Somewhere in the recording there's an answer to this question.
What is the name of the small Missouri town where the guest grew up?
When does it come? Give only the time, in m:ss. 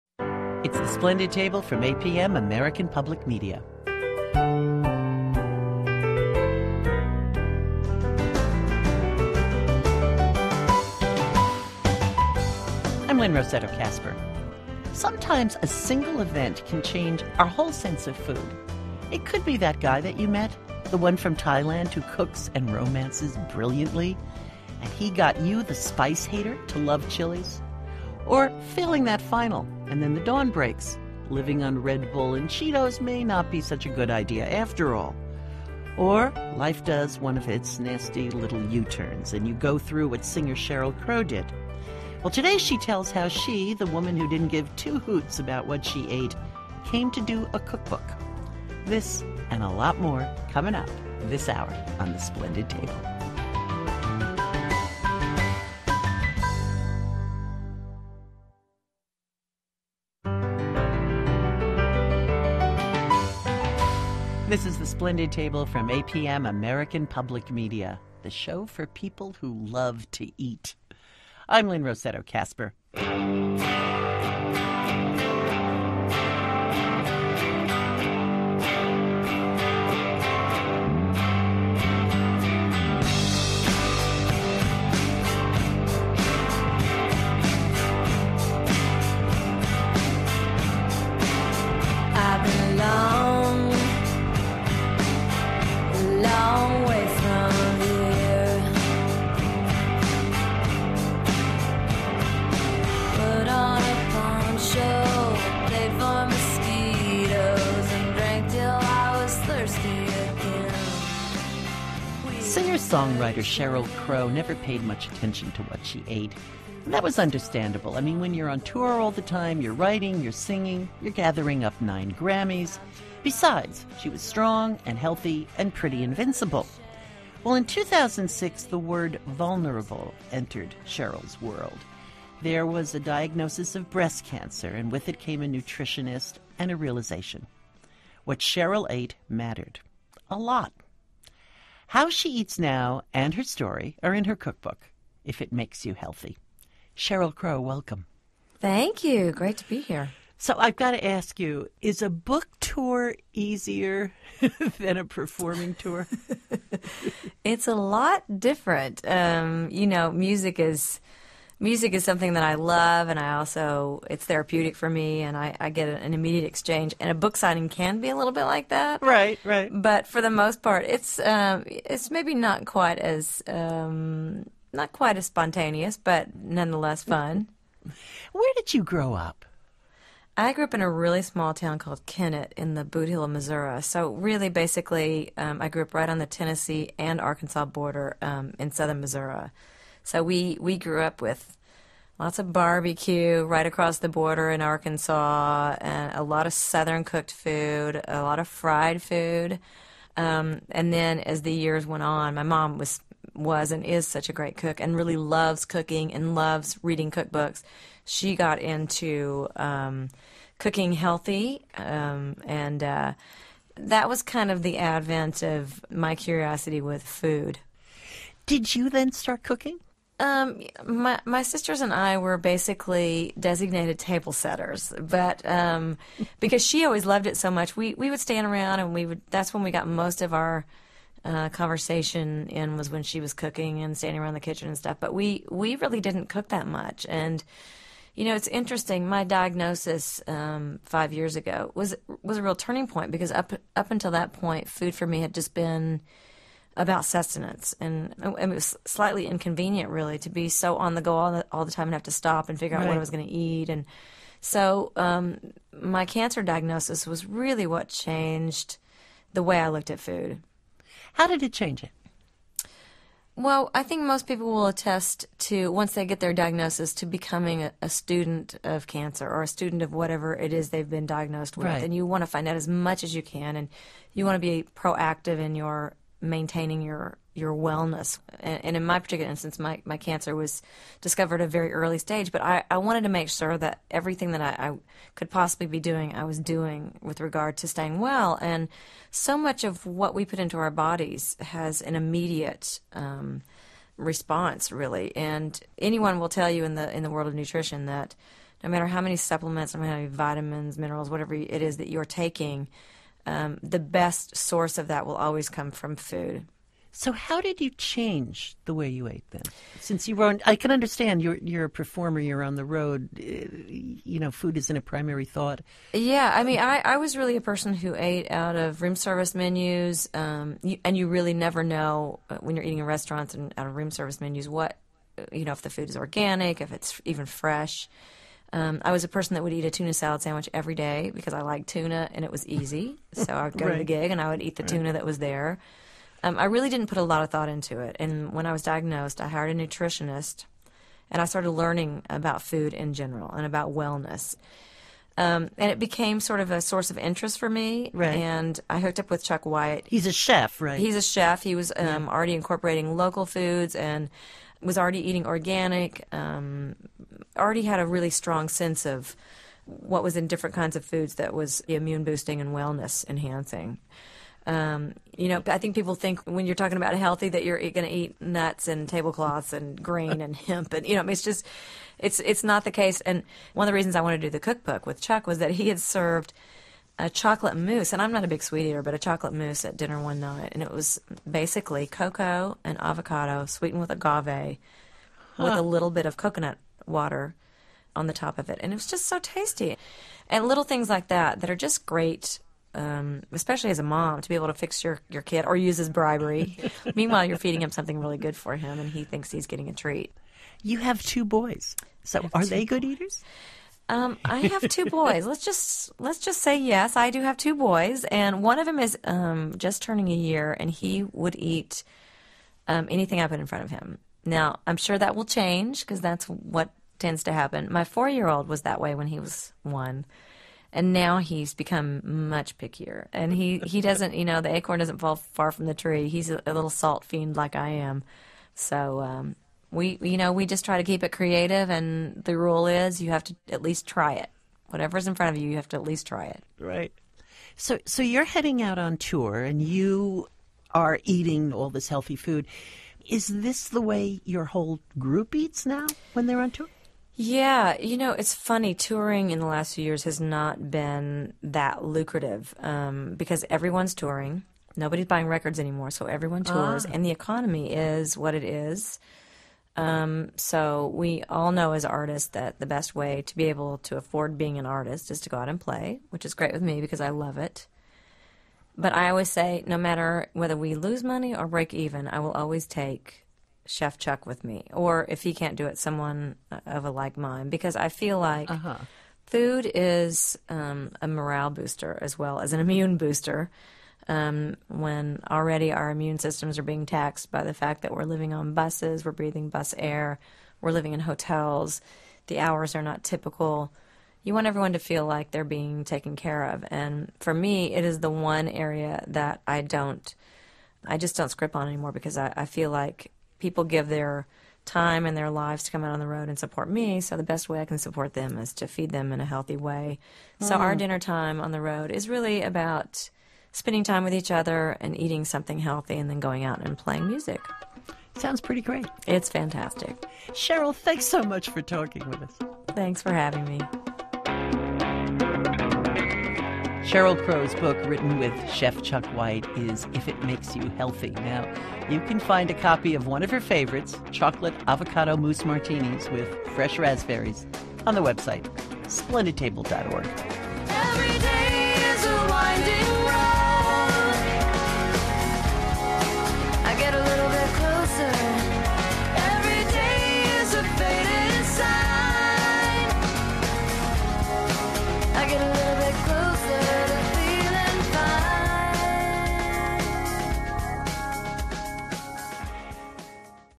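3:02.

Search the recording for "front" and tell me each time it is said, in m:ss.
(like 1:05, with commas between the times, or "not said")
6:53, 7:15.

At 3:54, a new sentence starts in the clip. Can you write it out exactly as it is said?
But we we really didn't cook that much, and you know it's interesting.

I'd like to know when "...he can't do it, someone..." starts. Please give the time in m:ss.
7:55.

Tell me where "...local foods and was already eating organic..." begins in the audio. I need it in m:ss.
5:52.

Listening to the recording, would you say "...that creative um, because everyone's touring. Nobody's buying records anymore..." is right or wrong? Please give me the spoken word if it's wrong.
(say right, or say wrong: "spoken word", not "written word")
wrong: "lucrative", not "creative".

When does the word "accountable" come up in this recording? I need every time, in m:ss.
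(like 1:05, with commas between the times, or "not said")
not said.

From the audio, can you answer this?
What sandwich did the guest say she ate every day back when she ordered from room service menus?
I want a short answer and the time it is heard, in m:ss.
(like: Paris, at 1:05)
Tuna salad sandwich, at 5:29.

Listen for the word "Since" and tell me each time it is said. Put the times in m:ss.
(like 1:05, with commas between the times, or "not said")
5:09.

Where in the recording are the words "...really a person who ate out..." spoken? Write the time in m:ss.
5:17.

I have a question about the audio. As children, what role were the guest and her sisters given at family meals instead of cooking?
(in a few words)
Table setters.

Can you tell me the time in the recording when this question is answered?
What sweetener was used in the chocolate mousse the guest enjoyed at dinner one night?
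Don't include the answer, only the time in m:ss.
6:23.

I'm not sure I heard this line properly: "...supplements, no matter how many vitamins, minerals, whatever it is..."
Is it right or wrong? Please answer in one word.
right.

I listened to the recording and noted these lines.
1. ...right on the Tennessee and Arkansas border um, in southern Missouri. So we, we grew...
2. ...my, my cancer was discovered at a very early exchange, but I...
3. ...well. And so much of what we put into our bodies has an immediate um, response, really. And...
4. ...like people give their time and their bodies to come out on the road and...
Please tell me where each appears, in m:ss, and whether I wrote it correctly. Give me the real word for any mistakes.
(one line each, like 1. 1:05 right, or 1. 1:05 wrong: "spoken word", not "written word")
1. 3:05 right
2. 4:39 wrong: "stage", not "exchange"
3. 4:47 right
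4. 8:22 wrong: "lives", not "bodies".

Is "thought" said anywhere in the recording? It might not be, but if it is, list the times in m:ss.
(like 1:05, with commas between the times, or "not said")
5:15, 5:37.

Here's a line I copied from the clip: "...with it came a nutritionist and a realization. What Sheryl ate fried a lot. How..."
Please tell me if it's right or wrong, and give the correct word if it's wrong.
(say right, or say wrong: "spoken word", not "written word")
wrong: "mattered", not "fried".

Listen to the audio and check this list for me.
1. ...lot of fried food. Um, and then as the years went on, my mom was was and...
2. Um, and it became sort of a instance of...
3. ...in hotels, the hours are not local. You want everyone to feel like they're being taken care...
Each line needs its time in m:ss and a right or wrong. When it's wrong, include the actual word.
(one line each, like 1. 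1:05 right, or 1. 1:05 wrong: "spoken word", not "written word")
1. 3:18 right
2. 5:45 wrong: "source", not "instance"
3. 8:10 wrong: "typical", not "local".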